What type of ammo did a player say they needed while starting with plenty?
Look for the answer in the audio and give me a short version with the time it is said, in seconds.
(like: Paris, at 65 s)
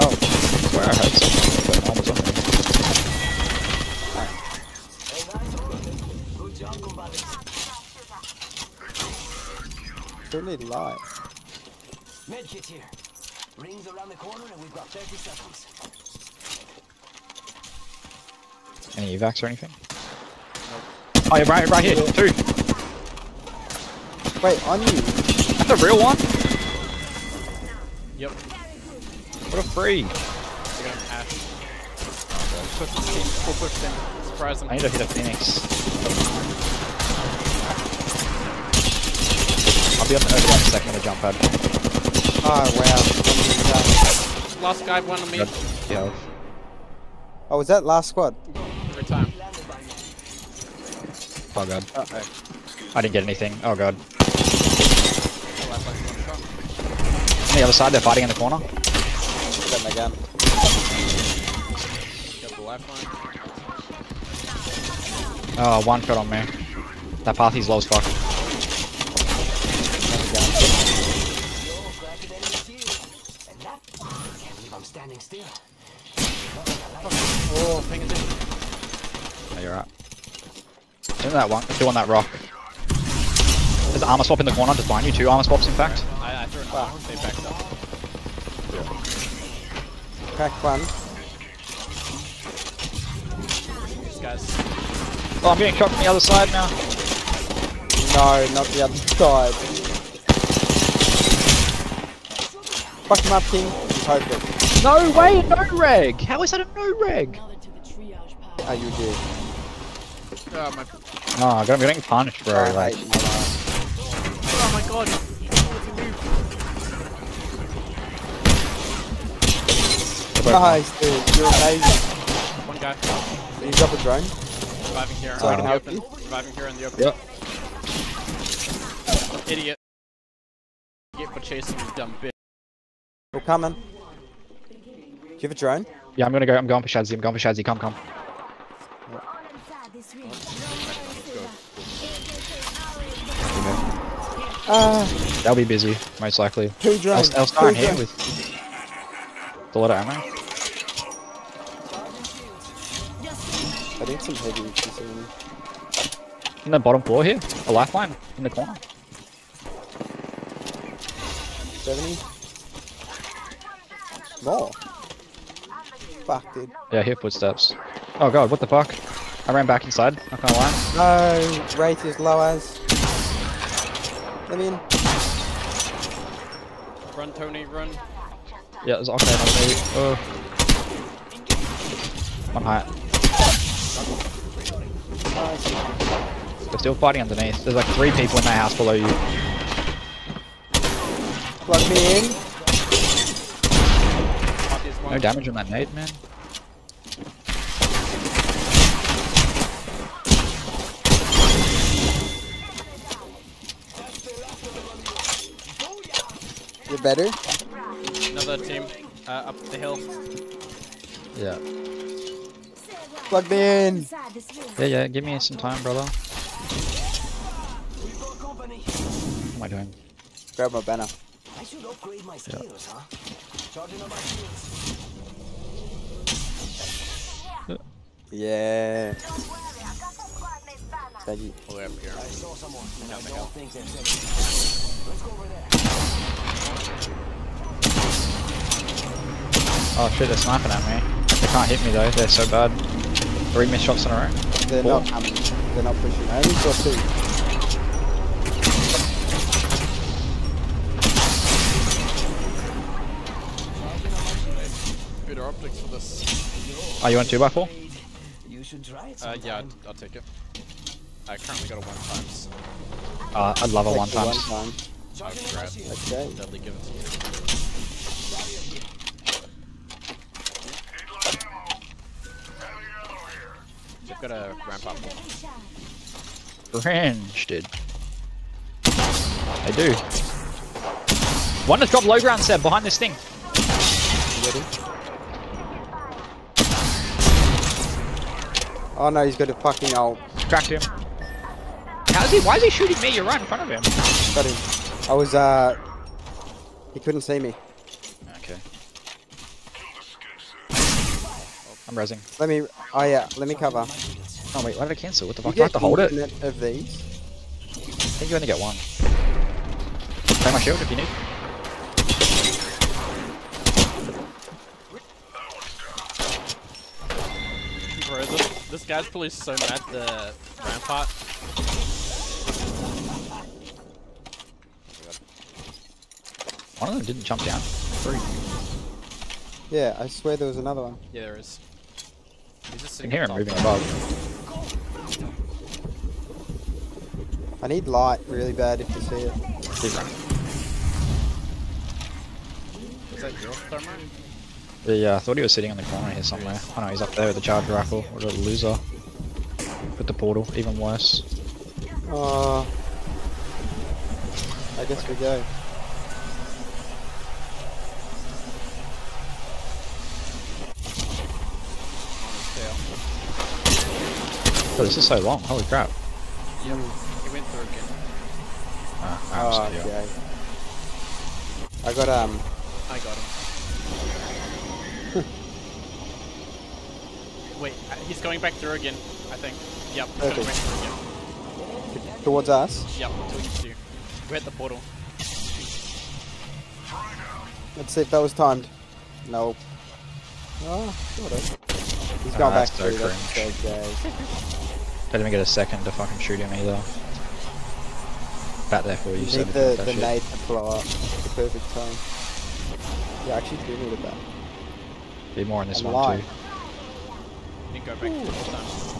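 heavy, at 154 s.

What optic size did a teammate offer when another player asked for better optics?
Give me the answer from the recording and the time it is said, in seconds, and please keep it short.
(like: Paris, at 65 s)
2x4, at 257 s.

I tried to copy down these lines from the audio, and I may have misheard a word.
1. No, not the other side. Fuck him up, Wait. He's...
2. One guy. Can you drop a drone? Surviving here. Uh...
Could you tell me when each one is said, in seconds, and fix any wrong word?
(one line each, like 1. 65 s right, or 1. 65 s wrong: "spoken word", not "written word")
1. 98 s wrong: "King", not "Wait"
2. 122 s right.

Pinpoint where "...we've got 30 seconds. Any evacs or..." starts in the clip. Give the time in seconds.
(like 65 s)
14 s.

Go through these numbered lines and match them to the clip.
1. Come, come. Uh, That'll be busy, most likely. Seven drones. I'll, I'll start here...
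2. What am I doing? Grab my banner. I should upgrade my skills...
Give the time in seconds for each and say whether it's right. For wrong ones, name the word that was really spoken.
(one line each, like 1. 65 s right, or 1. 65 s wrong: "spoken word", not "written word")
1. 137 s wrong: "Two", not "Seven"
2. 219 s right.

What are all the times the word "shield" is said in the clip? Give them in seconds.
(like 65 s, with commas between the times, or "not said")
310 s.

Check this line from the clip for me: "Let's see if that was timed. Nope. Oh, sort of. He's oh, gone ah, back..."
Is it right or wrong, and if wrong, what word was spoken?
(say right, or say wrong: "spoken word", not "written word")
right.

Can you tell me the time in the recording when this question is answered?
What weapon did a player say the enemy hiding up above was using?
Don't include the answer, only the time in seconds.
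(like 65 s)
347 s.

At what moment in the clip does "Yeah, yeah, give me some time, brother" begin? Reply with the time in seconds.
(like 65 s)
214 s.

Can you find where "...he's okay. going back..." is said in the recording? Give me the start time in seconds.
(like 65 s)
380 s.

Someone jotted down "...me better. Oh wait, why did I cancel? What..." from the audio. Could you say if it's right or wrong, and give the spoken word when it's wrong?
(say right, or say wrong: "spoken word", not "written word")
wrong: "cover", not "better".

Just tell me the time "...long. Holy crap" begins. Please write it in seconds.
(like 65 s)
365 s.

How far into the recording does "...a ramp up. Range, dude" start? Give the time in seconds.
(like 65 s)
274 s.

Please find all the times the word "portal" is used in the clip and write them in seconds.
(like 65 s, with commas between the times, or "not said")
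350 s, 384 s.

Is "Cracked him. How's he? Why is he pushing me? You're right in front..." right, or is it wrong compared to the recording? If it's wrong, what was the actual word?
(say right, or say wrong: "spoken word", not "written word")
wrong: "shooting", not "pushing".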